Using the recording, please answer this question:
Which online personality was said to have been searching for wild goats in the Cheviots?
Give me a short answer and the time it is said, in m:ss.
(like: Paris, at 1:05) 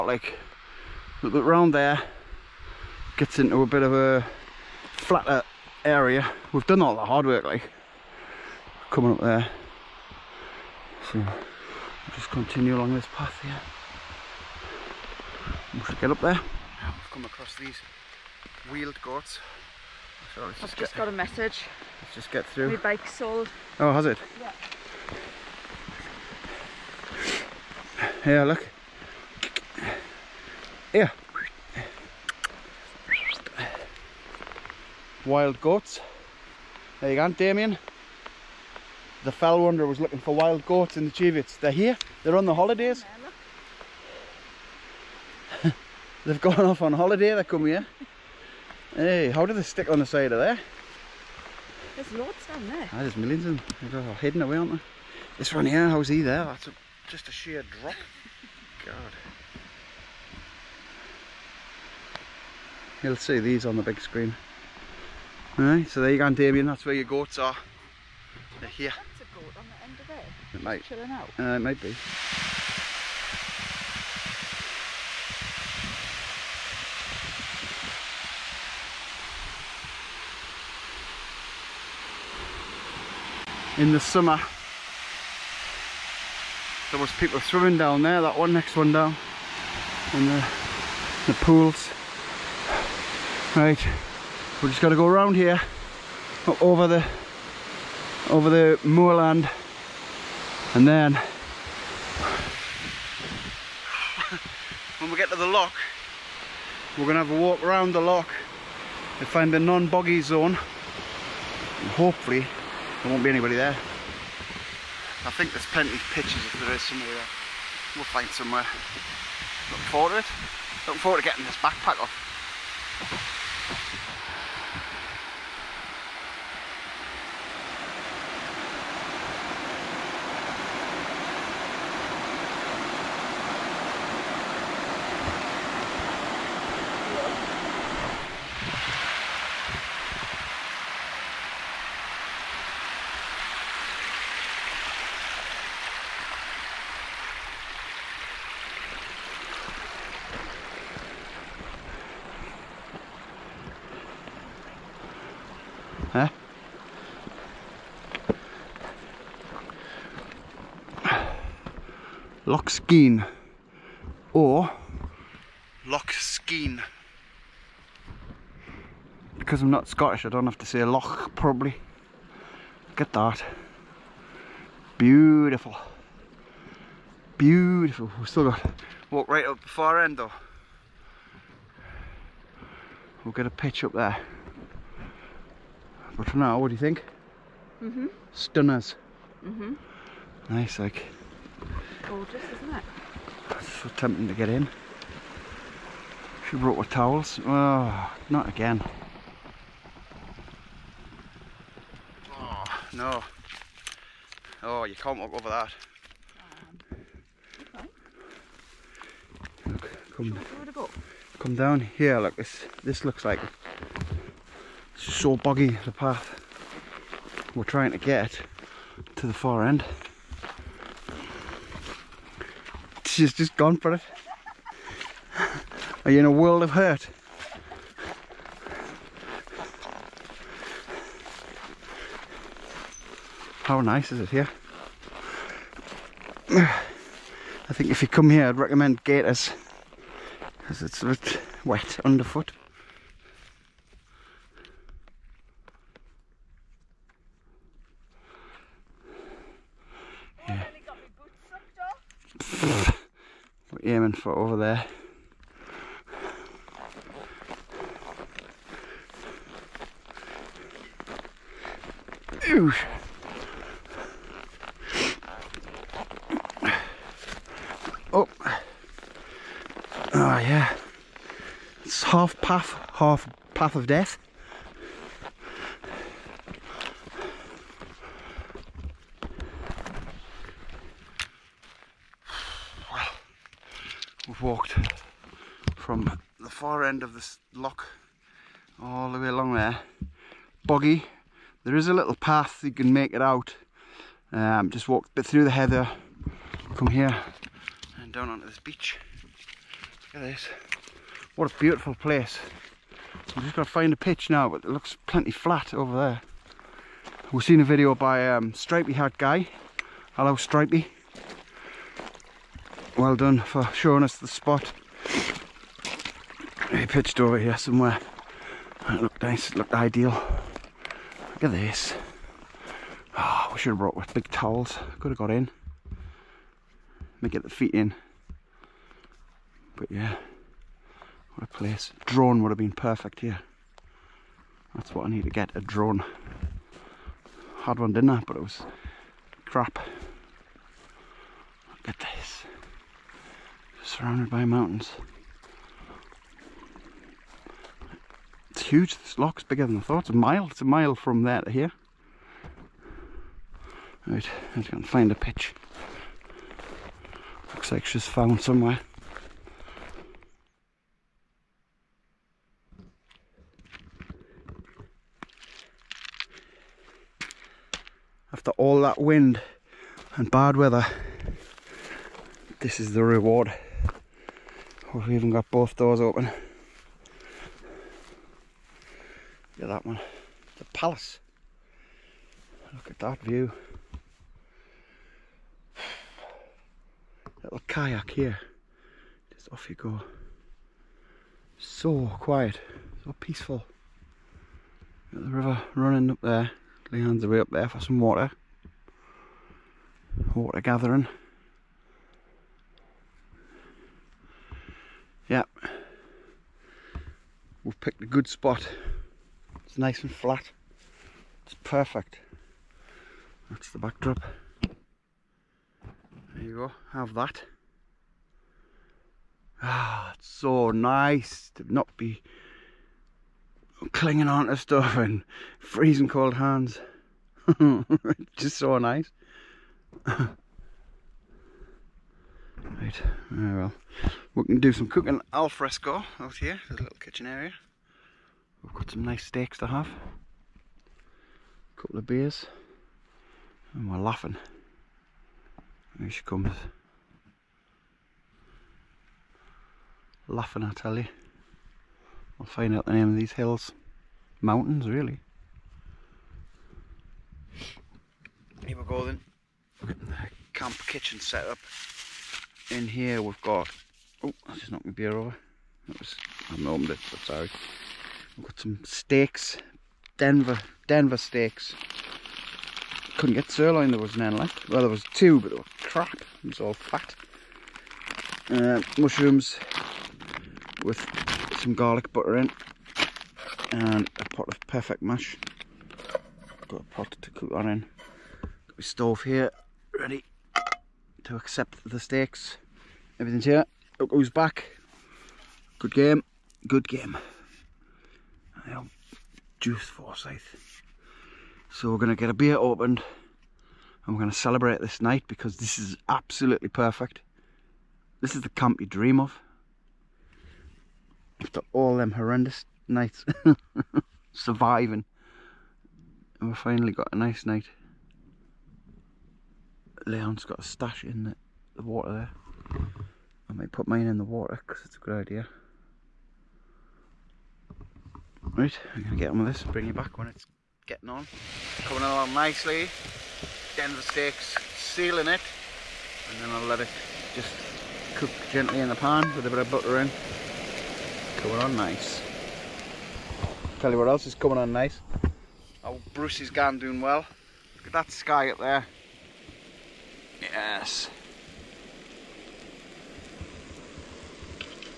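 Damien the fell wanderer, at 0:37.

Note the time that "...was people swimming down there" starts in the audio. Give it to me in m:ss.
1:26.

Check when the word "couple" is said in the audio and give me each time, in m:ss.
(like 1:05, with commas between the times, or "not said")
7:21.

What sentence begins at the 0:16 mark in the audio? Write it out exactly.
i have come across these wheeled goats.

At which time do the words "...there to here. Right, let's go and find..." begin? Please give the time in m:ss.
5:51.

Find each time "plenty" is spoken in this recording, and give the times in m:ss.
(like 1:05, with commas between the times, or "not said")
1:55, 5:05.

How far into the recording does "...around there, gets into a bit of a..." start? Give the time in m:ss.
0:01.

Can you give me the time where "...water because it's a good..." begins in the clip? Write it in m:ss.
8:44.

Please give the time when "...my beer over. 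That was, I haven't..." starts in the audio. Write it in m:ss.
7:44.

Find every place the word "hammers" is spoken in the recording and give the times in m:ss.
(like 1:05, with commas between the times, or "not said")
not said.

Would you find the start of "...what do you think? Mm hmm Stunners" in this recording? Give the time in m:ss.
3:06.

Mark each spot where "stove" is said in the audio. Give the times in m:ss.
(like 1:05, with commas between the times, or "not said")
8:08.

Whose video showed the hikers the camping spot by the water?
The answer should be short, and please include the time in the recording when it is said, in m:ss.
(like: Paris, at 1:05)
Stripey Hat Guy, at 5:08.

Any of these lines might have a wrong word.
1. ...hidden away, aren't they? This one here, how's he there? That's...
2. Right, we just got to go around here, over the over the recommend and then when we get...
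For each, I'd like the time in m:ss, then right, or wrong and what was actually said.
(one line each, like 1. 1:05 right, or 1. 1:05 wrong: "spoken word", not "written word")
1. 0:54 right
2. 1:33 wrong: "moorland", not "recommend".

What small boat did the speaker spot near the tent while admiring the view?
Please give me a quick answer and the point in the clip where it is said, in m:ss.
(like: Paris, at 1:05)
Kayak, at 6:27.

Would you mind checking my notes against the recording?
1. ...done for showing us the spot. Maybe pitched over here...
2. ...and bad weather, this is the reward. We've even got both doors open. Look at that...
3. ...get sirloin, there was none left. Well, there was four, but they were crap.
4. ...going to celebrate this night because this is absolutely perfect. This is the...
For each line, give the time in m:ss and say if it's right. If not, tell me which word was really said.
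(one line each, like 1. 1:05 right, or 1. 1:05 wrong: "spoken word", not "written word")
1. 5:13 right
2. 6:10 right
3. 7:53 wrong: "two", not "four"
4. 8:24 right.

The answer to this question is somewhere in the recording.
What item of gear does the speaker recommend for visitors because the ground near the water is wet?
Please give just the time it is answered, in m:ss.
3:59.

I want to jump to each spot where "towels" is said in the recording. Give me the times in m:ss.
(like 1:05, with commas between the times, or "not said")
3:16, 5:24.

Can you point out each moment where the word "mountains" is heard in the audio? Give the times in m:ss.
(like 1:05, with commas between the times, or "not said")
5:44, 7:34.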